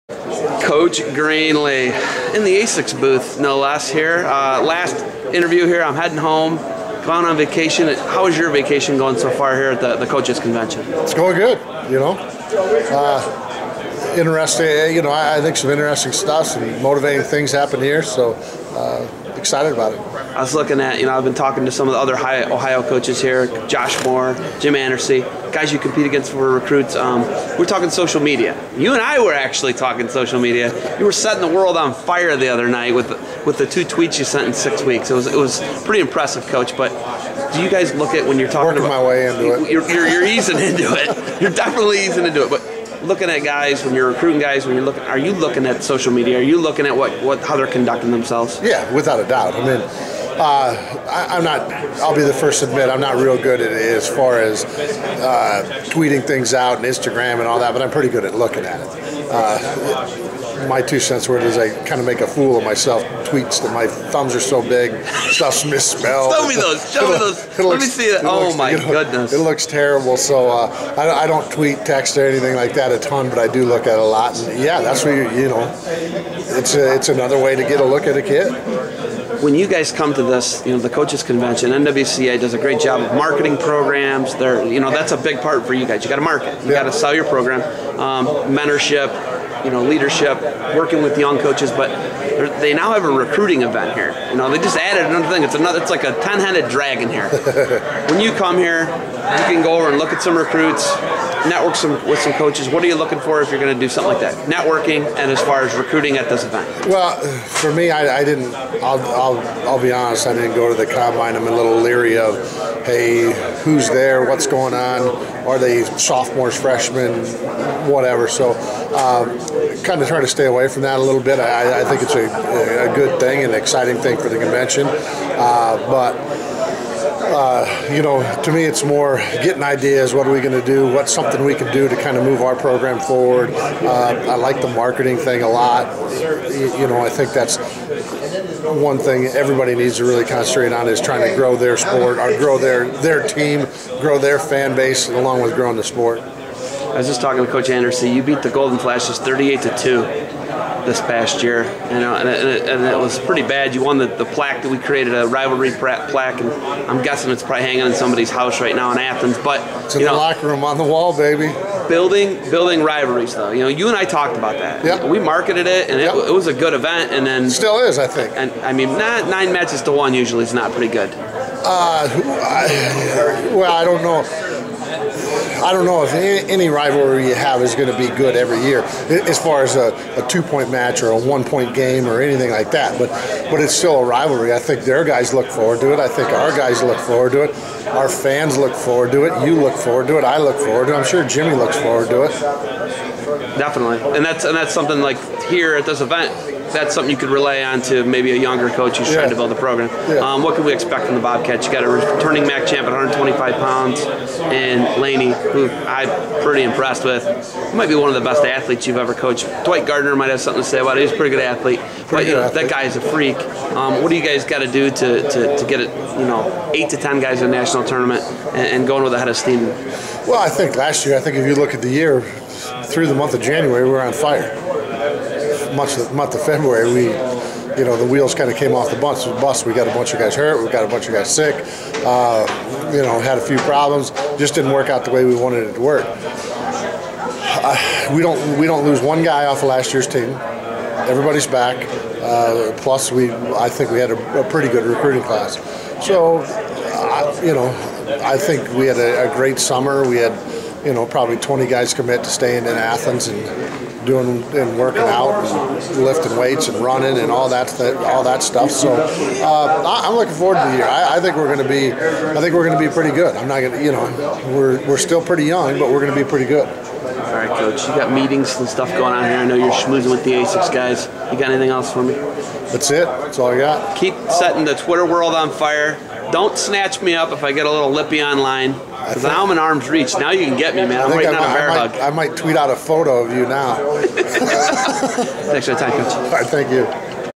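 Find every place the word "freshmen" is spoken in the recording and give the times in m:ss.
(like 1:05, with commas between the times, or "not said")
1:56.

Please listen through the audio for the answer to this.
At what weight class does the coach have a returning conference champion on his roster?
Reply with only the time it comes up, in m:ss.
3:22.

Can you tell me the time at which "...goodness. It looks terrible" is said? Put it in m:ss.
1:08.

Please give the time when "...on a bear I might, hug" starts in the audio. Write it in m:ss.
4:41.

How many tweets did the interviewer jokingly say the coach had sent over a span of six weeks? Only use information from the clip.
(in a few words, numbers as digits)
2.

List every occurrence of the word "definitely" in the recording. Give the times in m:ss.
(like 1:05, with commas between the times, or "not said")
0:41, 3:13.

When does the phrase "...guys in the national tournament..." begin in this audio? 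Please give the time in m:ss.
3:37.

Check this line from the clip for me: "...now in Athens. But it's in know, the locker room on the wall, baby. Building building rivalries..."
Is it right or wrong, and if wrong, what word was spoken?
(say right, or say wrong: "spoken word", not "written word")
right.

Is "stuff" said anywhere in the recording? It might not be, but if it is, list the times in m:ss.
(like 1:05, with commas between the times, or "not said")
0:16, 1:05, 4:18, 4:28.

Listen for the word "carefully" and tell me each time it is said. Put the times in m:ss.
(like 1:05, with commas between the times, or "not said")
not said.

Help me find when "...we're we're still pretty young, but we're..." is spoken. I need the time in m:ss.
4:24.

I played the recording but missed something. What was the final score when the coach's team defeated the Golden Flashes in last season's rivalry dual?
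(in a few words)
38 to 2.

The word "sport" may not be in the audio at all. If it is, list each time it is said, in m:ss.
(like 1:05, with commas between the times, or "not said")
2:21, 2:25.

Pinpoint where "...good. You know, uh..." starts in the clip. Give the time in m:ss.
0:11.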